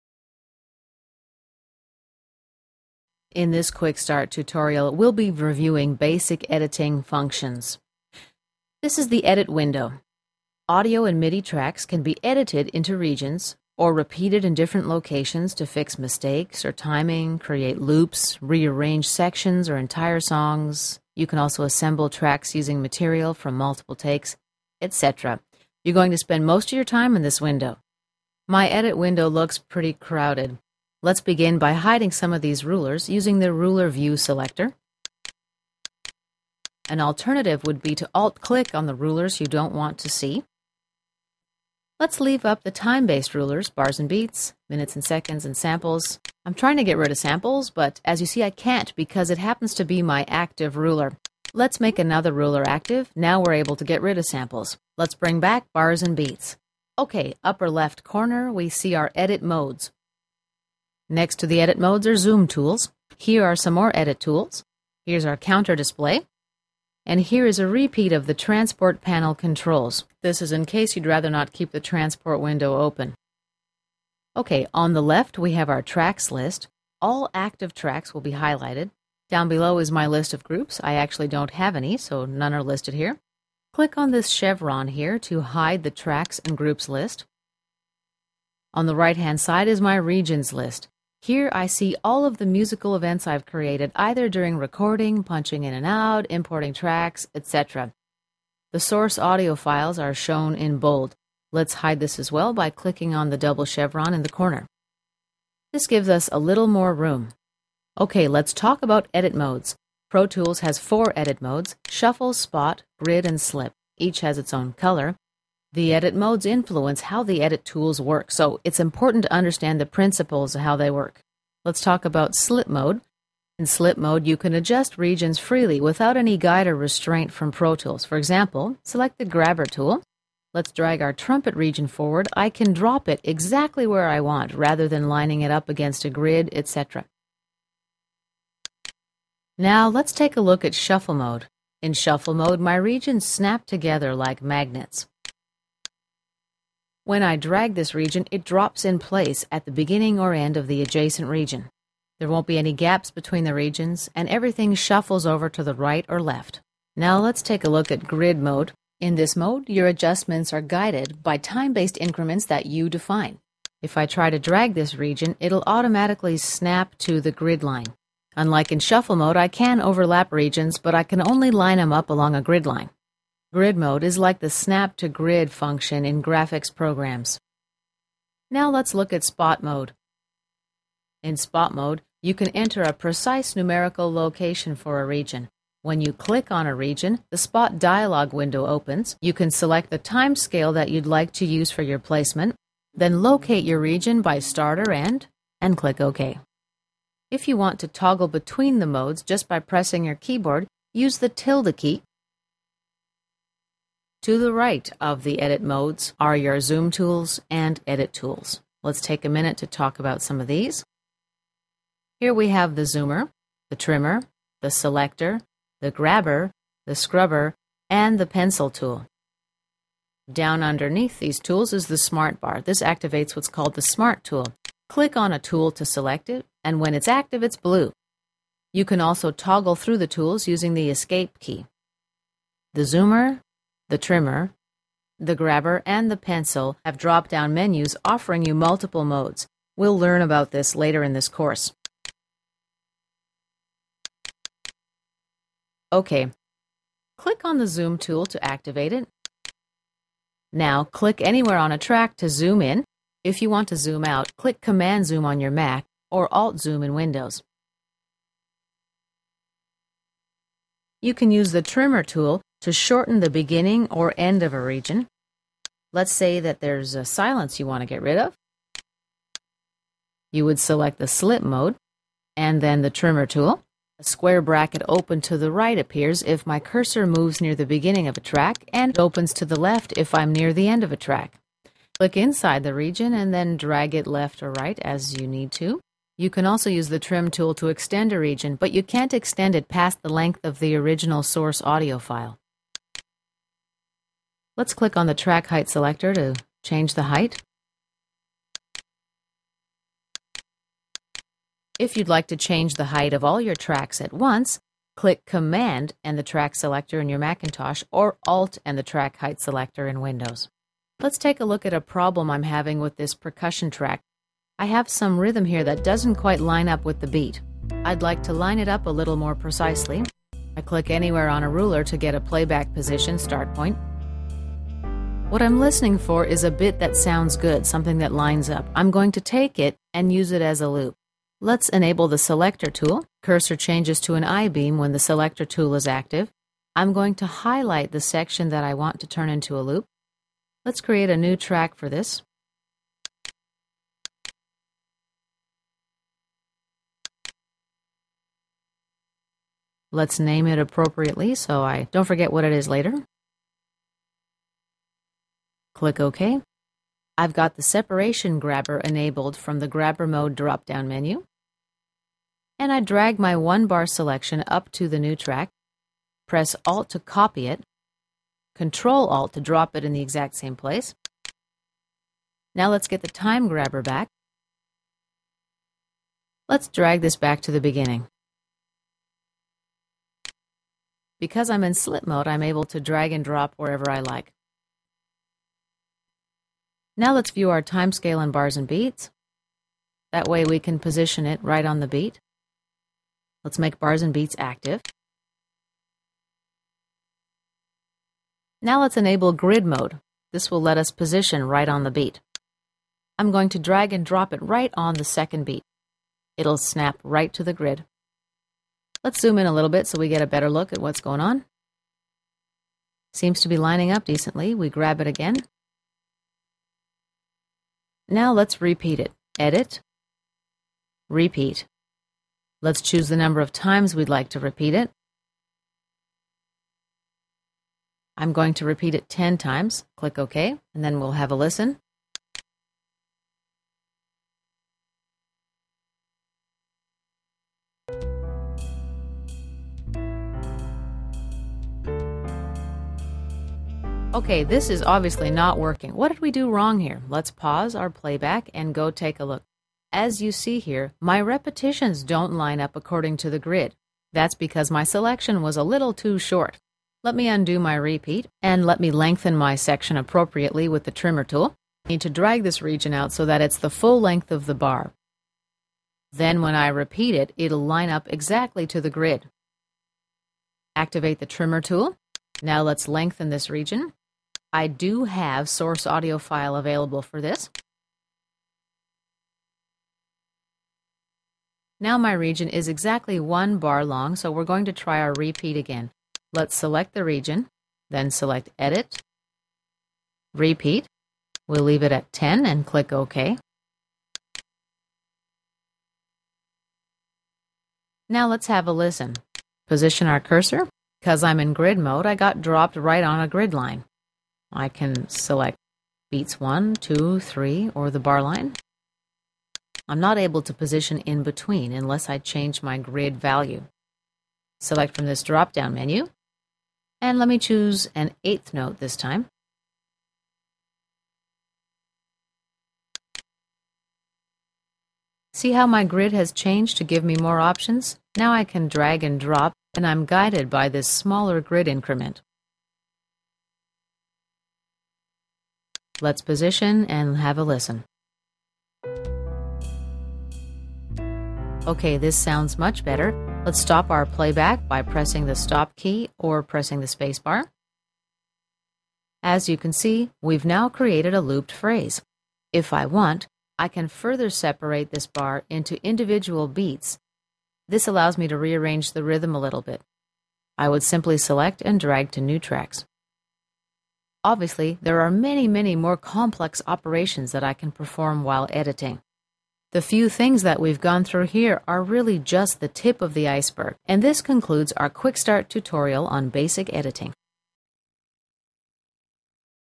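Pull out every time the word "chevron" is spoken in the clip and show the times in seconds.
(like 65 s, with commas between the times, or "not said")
84 s, 103 s.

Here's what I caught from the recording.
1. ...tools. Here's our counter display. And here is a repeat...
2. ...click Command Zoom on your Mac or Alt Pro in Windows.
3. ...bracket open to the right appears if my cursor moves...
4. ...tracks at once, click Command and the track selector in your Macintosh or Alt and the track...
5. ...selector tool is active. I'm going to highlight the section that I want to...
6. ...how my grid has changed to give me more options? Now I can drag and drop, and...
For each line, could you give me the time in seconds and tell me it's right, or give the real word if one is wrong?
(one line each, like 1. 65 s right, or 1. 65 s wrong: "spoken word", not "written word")
1. 64 s right
2. 254 s wrong: "Zoom", not "Pro"
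3. 274 s right
4. 303 s right
5. 334 s right
6. 525 s right.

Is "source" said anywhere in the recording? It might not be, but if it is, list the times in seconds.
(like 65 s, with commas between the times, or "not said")
98 s, 291 s, 475 s.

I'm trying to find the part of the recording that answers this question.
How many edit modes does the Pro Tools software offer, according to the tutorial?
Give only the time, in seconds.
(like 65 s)
110 s.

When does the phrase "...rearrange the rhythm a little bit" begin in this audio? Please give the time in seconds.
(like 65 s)
558 s.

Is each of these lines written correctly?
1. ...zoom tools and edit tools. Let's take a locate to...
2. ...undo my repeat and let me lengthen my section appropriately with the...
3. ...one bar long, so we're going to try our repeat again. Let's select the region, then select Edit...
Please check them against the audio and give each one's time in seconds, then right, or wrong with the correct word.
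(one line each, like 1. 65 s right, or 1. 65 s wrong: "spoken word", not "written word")
1. 206 s wrong: "minute", not "locate"
2. 457 s right
3. 483 s right.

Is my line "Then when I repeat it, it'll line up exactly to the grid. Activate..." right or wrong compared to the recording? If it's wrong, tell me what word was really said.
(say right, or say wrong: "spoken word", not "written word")
right.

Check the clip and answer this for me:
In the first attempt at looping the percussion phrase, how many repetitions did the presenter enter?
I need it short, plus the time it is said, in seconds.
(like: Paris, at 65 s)
10, at 429 s.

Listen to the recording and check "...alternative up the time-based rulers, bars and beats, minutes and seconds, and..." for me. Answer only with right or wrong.
wrong.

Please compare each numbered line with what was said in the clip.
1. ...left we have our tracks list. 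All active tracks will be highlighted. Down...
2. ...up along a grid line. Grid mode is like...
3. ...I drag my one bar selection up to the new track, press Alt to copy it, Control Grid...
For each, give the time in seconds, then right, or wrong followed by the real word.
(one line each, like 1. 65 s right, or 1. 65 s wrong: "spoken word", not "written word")
1. 75 s right
2. 171 s right
3. 362 s wrong: "Alt", not "Grid".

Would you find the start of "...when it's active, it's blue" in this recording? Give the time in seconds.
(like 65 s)
226 s.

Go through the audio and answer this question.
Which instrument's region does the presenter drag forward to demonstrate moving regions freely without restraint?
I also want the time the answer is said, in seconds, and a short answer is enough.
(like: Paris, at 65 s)
Trumpet, at 131 s.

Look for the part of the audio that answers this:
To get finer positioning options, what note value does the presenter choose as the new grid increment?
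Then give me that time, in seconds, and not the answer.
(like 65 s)
518 s.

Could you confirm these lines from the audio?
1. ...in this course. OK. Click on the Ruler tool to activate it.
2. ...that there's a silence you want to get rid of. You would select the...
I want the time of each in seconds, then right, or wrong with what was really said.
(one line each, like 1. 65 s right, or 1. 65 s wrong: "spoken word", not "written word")
1. 241 s wrong: "Zoom", not "Ruler"
2. 266 s right.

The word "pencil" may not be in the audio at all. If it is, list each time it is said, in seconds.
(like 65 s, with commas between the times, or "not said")
218 s, 236 s.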